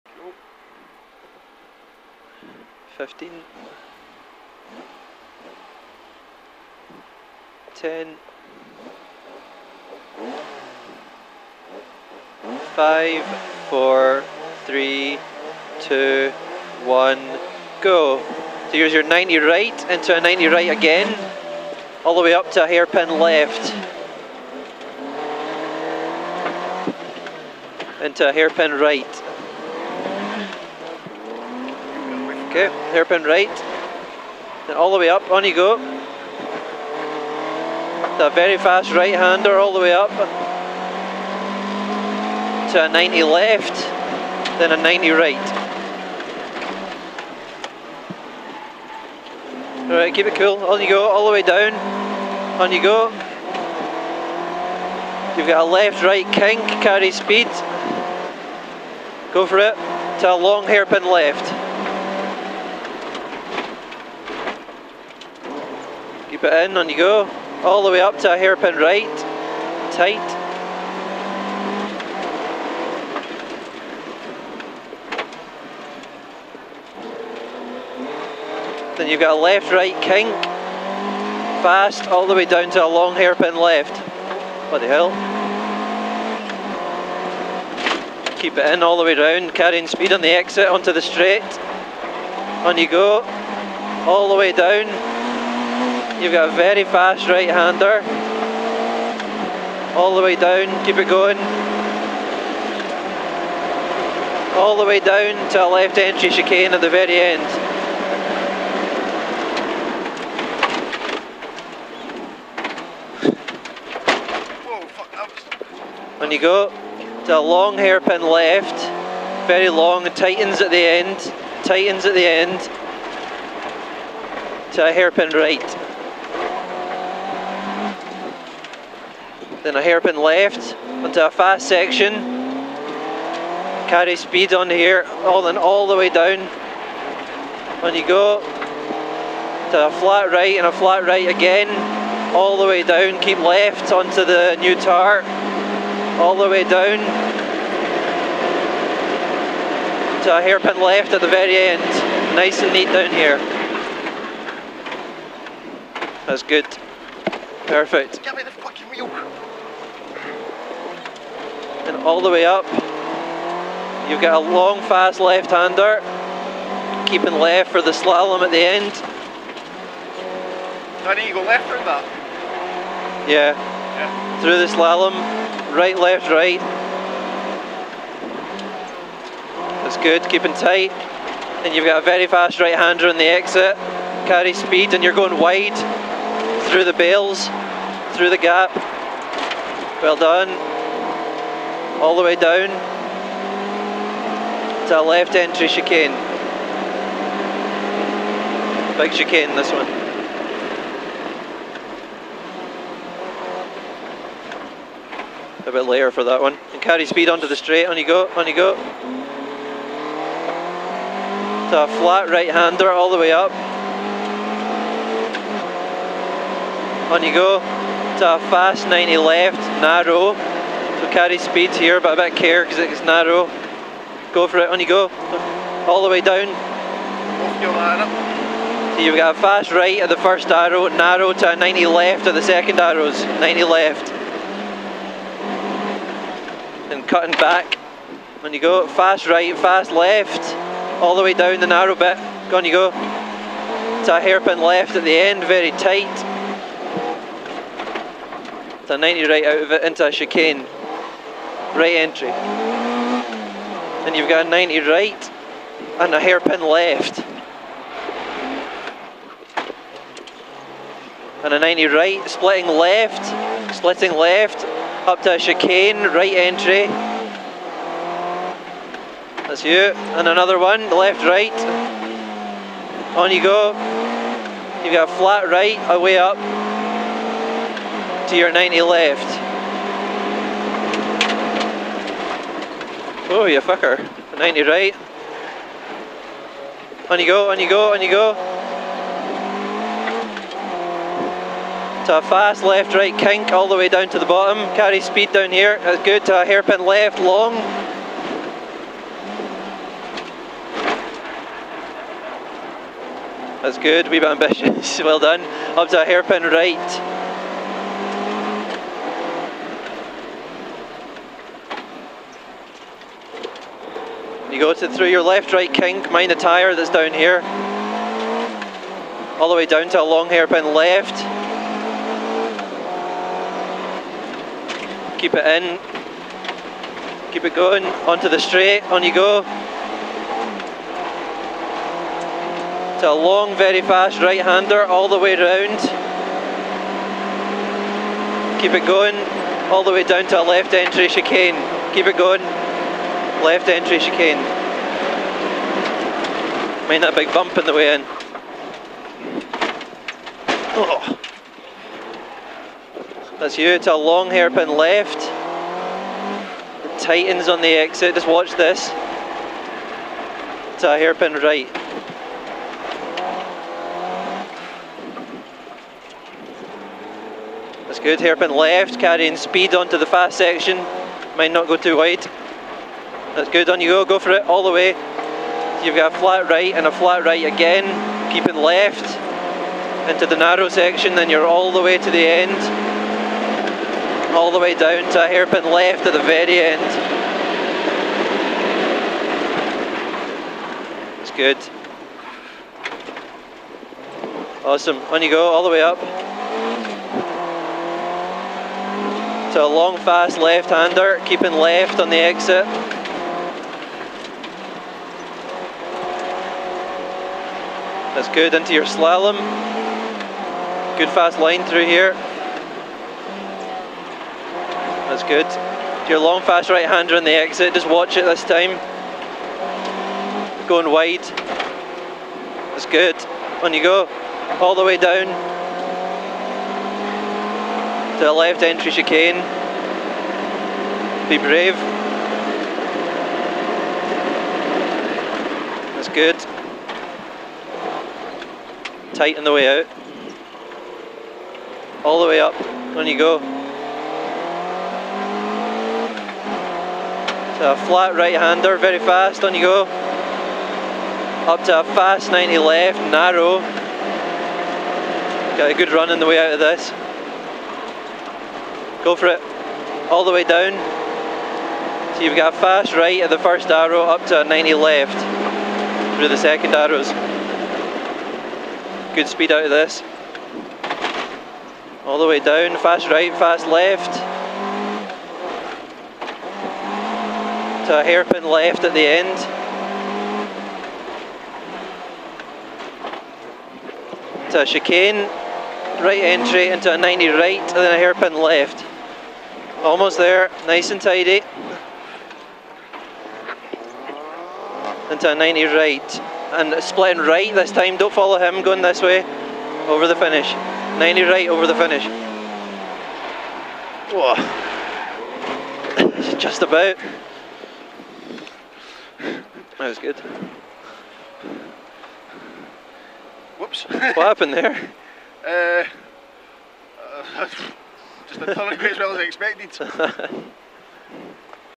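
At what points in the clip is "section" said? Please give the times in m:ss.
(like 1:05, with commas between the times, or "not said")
2:11, 6:10, 6:20.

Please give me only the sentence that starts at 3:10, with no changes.
Well done all the way down to a left entry chicane.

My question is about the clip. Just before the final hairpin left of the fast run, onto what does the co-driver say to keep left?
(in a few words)
the new tar.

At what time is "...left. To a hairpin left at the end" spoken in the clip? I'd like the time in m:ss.
7:53.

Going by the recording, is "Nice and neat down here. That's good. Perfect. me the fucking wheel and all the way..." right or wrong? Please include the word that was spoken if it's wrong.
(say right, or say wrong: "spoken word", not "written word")
right.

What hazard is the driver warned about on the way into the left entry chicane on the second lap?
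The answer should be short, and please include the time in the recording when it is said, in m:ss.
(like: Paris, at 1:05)
big bump, at 5:47.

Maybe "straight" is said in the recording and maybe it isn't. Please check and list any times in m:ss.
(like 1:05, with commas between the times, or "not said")
1:31, 3:27, 5:28.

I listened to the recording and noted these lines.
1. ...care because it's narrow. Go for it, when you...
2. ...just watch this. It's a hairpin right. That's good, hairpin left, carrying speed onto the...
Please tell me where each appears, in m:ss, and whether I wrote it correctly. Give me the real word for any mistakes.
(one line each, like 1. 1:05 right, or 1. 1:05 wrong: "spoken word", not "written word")
1. 3:42 right
2. 5:58 right.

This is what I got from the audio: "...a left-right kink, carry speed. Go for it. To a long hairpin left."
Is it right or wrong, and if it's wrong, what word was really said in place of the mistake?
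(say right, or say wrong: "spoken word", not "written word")
right.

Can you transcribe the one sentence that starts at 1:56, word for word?
and you go to a long hairpin left, very long, tightens at the end, tightens at the end, to a hairpin right.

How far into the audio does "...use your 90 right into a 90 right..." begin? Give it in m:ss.
0:18.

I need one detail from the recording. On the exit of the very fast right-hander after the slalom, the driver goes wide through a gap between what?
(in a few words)
the bales.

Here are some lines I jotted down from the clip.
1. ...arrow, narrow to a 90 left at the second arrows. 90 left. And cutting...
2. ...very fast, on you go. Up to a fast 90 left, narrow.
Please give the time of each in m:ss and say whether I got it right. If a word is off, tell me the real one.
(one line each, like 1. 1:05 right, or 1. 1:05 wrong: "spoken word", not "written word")
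1. 3:50 right
2. 7:28 right.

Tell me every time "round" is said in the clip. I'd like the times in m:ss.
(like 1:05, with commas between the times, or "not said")
1:29, 5:35.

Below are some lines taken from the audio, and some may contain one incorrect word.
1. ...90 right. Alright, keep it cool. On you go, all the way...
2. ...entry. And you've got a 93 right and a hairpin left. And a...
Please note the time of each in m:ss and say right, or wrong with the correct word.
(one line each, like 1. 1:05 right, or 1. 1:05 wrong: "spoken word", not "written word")
1. 0:44 right
2. 4:11 wrong: "90", not "93".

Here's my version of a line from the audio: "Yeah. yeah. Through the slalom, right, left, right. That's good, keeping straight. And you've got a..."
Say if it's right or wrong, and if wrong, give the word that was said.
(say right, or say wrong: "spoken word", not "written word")
wrong: "tight", not "straight".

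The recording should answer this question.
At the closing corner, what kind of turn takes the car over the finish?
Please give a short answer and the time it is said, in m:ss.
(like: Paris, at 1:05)
90 right, at 8:20.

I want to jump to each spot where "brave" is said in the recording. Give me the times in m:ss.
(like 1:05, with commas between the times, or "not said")
7:11.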